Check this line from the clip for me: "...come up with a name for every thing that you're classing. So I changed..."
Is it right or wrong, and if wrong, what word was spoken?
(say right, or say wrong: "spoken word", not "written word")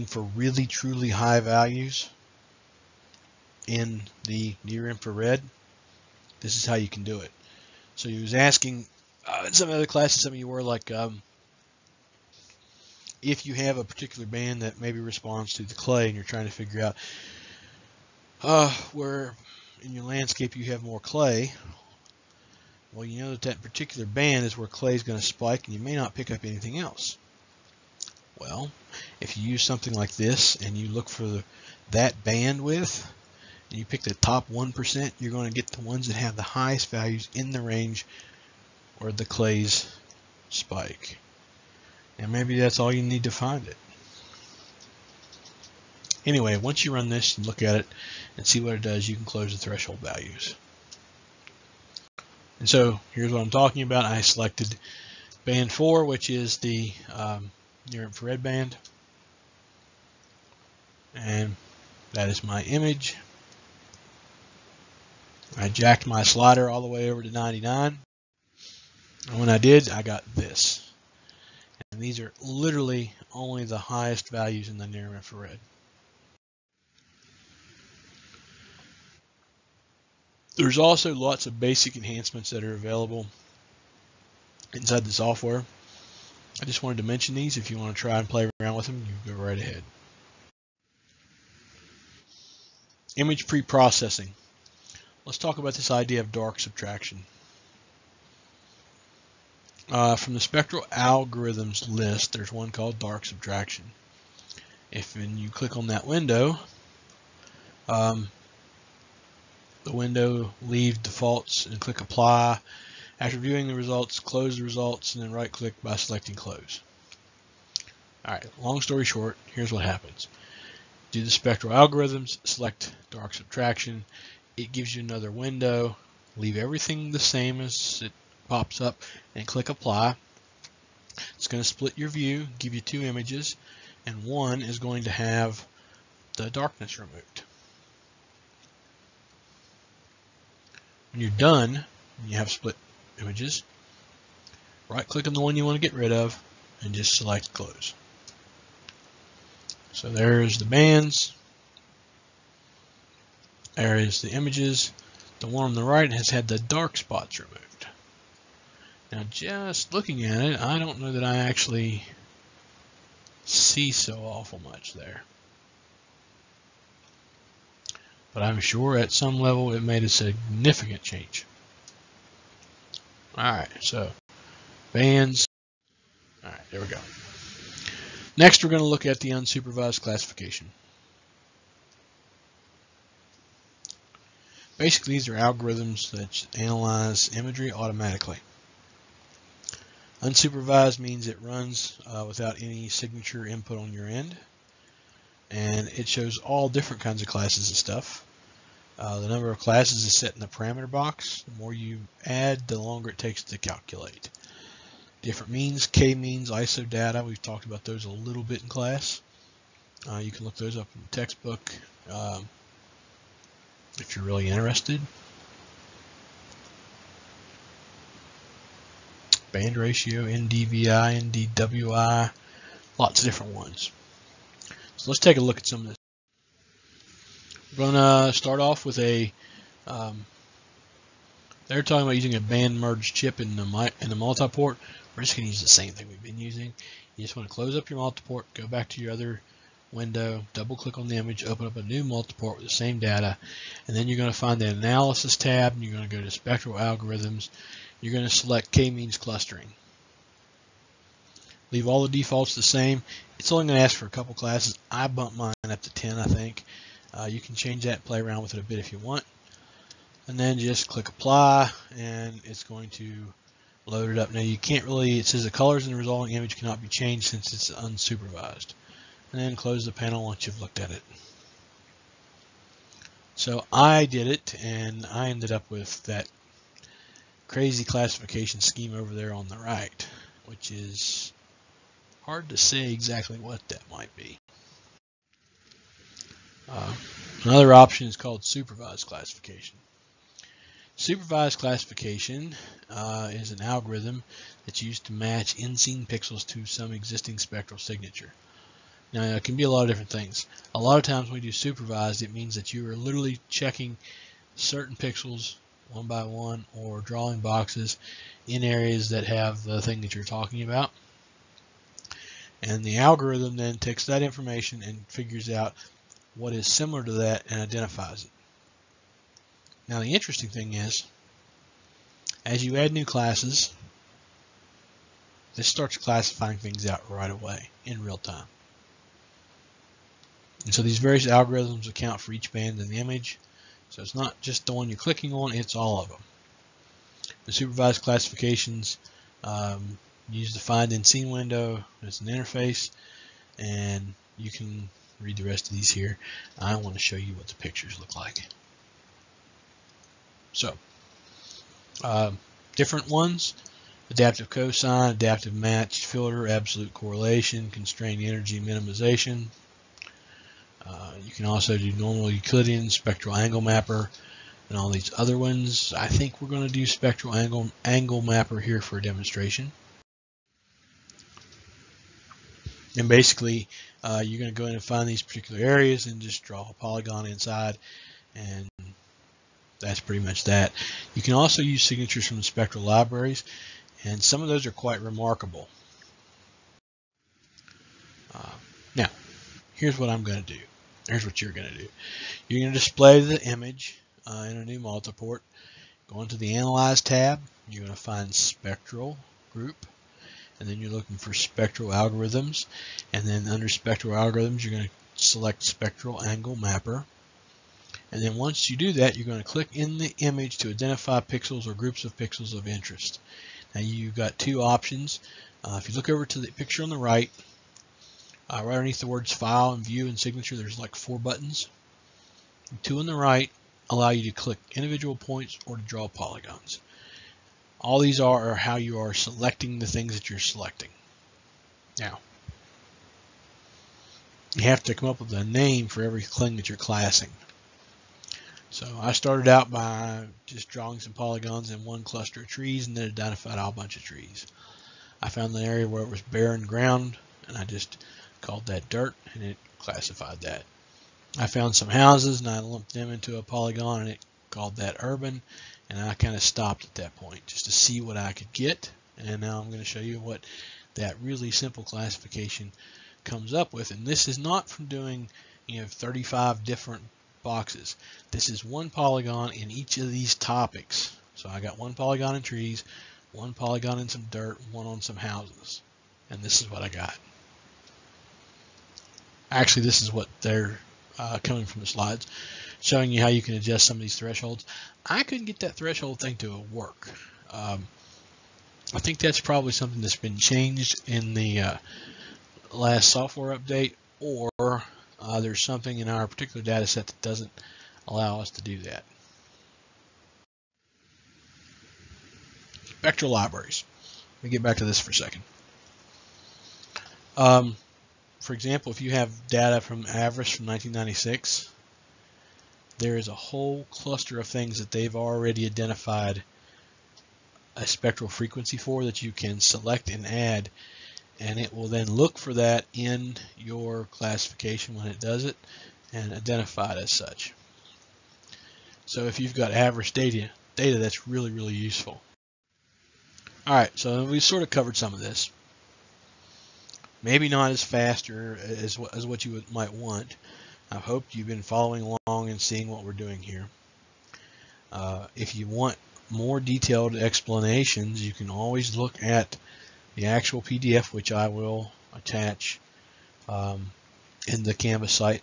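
wrong: "started", not "changed".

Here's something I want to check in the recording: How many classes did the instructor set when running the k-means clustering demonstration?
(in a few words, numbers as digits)
10.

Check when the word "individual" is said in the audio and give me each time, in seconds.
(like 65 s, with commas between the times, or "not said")
424 s.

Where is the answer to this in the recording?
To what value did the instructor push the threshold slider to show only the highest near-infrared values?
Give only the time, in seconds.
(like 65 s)
67 s.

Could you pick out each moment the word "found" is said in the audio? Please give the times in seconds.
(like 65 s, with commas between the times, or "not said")
445 s, 451 s.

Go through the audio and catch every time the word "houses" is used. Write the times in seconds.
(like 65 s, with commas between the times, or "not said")
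451 s, 475 s.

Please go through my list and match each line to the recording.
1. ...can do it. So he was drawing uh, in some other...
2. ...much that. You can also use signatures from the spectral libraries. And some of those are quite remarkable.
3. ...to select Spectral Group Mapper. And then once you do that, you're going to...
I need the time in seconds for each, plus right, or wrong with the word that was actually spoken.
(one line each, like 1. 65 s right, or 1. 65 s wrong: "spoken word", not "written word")
1. 6 s wrong: "asking", not "drawing"
2. 380 s right
3. 404 s wrong: "Angle", not "Group".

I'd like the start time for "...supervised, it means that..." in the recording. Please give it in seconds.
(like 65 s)
301 s.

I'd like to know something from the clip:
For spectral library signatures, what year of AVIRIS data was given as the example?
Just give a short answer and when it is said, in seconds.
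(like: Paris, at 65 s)
1996, at 510 s.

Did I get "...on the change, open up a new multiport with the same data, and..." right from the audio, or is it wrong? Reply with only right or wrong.
wrong.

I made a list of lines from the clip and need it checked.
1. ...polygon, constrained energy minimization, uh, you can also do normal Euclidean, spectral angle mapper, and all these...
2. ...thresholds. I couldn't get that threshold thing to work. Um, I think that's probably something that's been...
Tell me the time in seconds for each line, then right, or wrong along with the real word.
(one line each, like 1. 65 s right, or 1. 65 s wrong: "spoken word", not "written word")
1. 356 s wrong: "correlation", not "polygon"
2. 484 s right.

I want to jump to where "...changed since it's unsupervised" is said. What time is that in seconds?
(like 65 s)
266 s.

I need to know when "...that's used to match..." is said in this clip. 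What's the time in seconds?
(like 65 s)
294 s.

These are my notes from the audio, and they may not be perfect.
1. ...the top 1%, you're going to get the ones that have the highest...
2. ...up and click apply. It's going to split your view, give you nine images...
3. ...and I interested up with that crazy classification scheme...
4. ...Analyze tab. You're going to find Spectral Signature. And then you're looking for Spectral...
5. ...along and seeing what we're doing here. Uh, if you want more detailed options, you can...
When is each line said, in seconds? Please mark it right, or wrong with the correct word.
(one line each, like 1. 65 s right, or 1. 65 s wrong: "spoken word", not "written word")
1. 34 s right
2. 128 s wrong: "two", not "nine"
3. 274 s wrong: "ended", not "interested"
4. 396 s wrong: "Group", not "Signature"
5. 542 s wrong: "explanations", not "options".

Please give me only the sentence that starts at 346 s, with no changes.
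I want to show you what the pictures look like.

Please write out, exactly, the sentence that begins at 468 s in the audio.
This is one polygon in each of these topics.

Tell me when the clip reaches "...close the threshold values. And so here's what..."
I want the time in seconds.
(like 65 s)
49 s.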